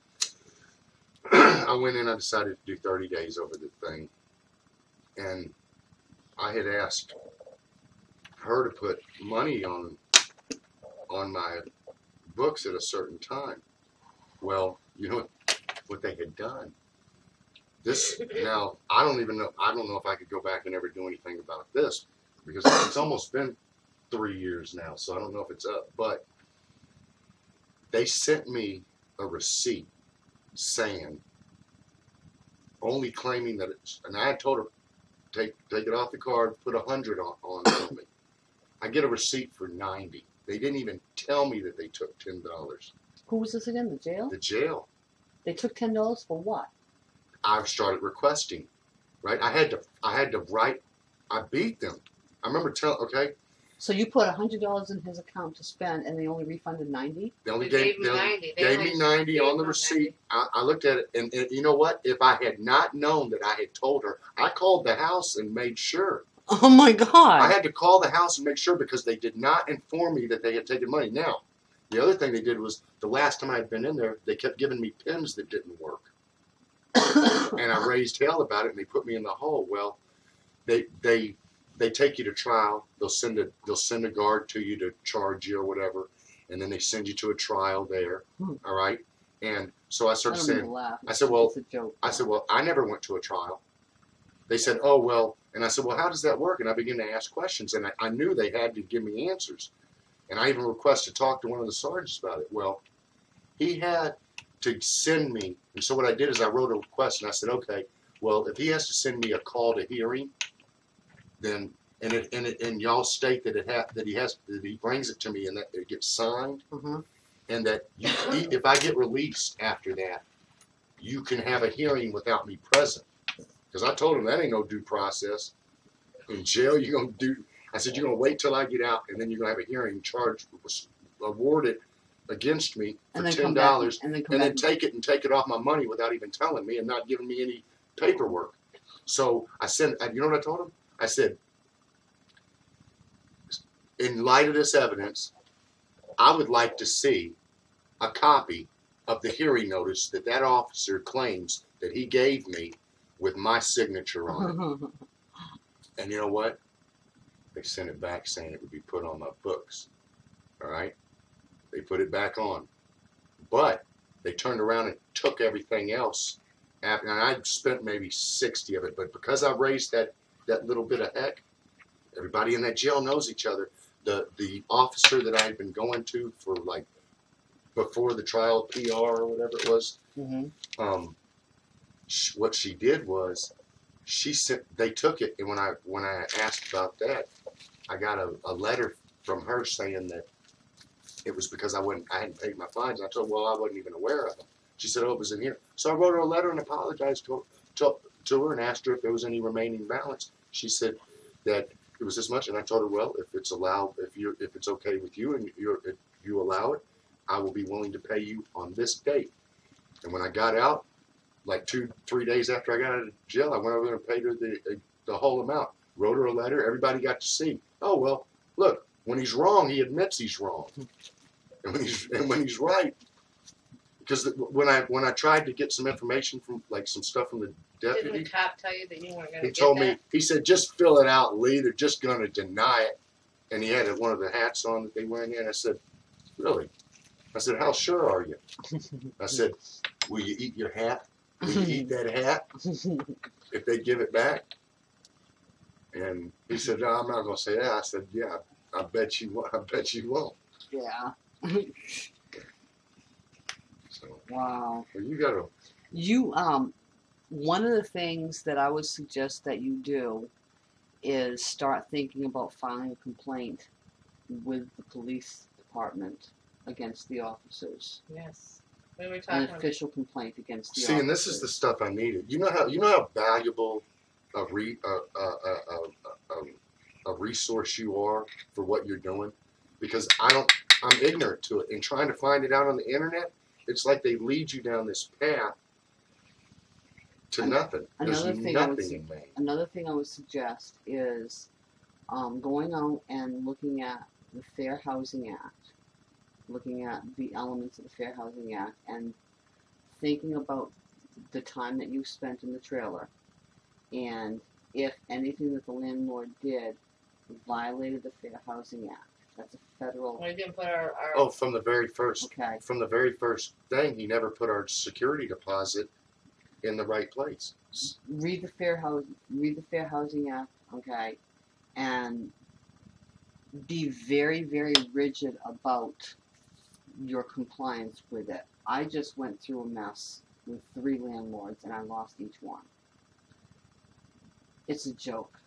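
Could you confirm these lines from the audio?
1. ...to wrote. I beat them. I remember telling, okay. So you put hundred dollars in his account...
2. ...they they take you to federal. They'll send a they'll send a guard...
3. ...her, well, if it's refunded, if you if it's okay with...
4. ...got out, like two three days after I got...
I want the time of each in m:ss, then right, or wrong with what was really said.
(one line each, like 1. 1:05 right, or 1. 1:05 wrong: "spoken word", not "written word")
1. 0:50 wrong: "write", not "wrote"
2. 1:21 wrong: "trial", not "federal"
3. 3:22 wrong: "allowed", not "refunded"
4. 3:30 right.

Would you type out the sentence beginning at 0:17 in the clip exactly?
This now, I don't even know.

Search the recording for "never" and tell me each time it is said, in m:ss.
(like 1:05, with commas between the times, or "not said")
1:32, 5:14.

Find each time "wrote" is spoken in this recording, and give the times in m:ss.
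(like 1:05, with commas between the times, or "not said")
1:46, 3:15, 3:35.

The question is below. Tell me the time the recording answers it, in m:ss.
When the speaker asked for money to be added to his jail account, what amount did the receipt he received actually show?
0:38.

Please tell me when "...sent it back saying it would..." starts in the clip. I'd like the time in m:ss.
2:37.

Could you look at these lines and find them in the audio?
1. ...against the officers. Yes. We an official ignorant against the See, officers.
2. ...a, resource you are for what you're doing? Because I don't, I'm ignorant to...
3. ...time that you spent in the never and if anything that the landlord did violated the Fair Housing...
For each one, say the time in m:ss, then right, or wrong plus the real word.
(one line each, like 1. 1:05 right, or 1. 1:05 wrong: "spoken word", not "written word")
1. 4:26 wrong: "complaint", not "ignorant"
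2. 4:37 right
3. 5:01 wrong: "trailer", not "never".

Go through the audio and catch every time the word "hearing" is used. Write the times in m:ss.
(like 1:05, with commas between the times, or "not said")
1:49, 2:01, 2:09, 2:29.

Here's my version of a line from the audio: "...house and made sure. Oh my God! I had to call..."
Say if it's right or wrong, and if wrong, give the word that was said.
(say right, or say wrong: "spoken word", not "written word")
right.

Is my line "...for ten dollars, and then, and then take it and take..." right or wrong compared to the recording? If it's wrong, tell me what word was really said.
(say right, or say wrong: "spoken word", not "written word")
right.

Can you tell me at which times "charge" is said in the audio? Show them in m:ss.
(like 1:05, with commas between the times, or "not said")
1:25, 2:10.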